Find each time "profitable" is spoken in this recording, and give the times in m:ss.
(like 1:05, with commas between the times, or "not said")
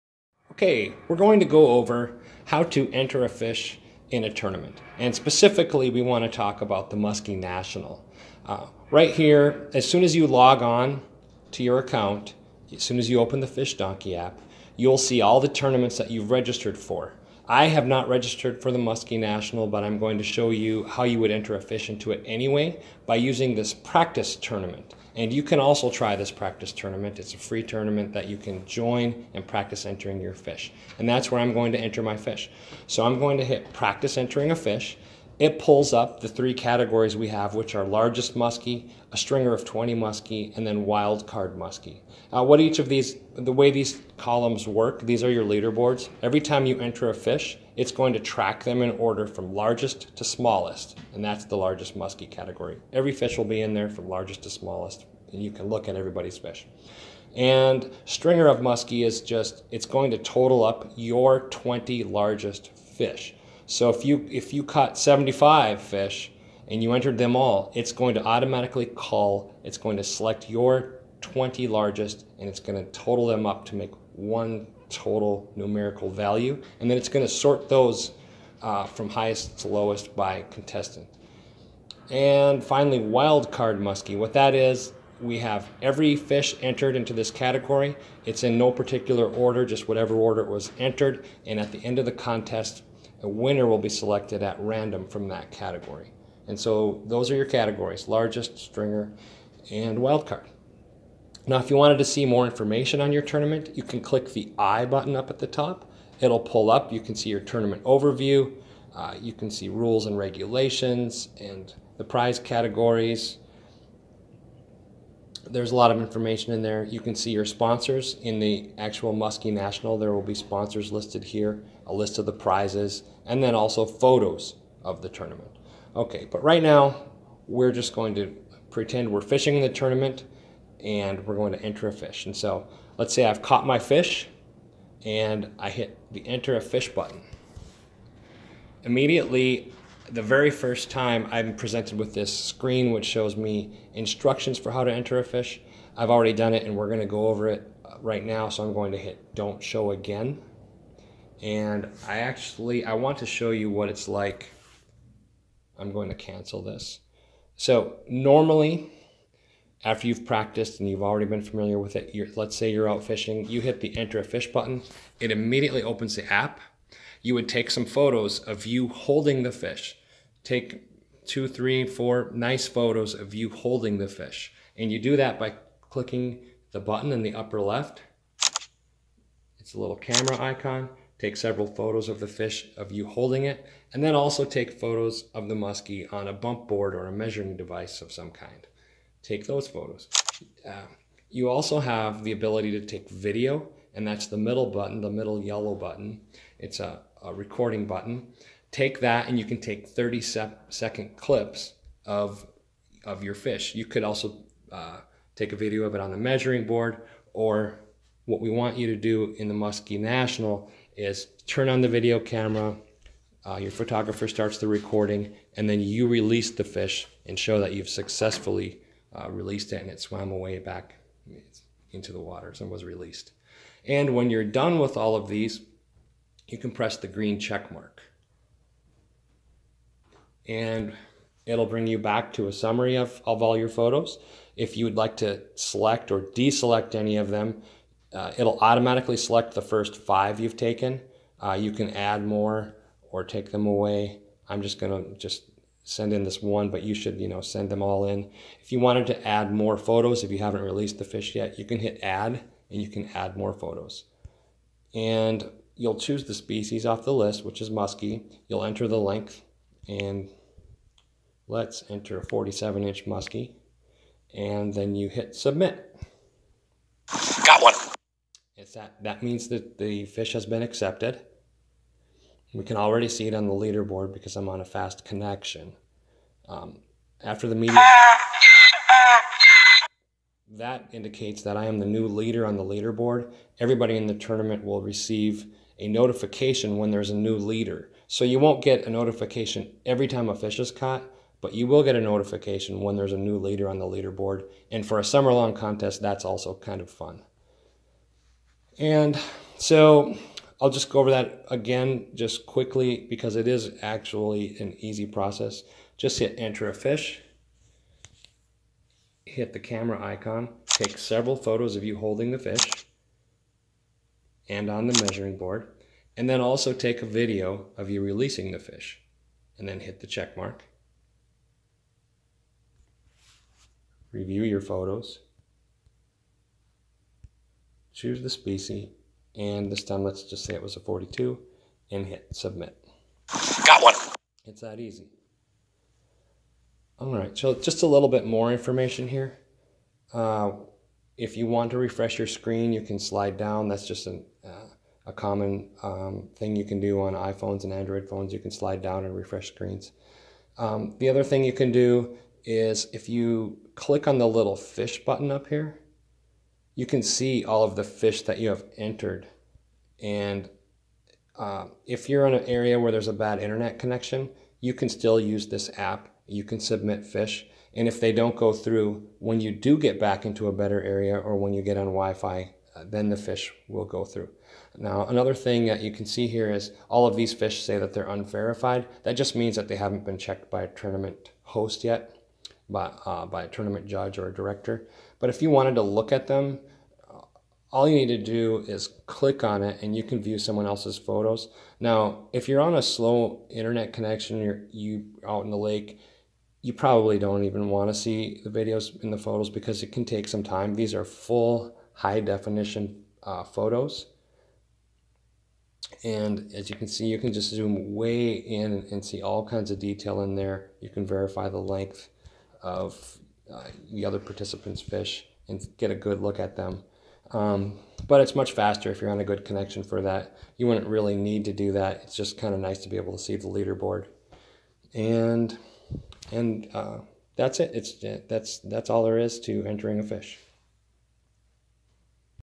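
not said.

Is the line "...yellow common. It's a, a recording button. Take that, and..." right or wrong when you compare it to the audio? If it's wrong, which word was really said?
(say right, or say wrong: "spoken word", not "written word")
wrong: "button", not "common".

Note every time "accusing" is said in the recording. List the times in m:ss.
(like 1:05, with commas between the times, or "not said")
not said.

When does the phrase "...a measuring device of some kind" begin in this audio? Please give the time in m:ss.
3:07.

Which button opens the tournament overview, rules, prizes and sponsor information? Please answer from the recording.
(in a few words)
The I button.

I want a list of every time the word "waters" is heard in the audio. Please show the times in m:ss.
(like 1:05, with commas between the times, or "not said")
3:42.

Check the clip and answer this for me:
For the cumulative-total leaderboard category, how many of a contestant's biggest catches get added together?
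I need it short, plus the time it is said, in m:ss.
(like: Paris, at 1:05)
20, at 1:01.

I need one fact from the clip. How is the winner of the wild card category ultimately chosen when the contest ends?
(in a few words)
At random.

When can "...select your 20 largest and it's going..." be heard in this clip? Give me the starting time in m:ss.
1:10.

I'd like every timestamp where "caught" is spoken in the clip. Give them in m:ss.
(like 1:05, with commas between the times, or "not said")
1:04, 2:13, 4:50.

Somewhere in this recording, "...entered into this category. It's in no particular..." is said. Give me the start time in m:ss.
1:26.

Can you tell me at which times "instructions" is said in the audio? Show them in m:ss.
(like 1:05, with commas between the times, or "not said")
2:23.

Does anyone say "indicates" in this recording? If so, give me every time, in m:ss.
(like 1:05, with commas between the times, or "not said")
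4:40.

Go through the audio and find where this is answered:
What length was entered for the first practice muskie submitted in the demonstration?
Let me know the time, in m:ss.
4:22.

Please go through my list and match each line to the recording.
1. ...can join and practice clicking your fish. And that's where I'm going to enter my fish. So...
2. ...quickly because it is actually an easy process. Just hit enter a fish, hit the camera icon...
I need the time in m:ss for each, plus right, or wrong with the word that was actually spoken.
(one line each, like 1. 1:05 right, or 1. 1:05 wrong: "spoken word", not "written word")
1. 0:28 wrong: "entering", not "clicking"
2. 5:02 right.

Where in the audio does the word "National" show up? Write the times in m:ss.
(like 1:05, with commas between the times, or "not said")
0:07, 0:19, 1:59, 3:29.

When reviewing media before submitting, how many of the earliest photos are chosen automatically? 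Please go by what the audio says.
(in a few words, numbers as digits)
5.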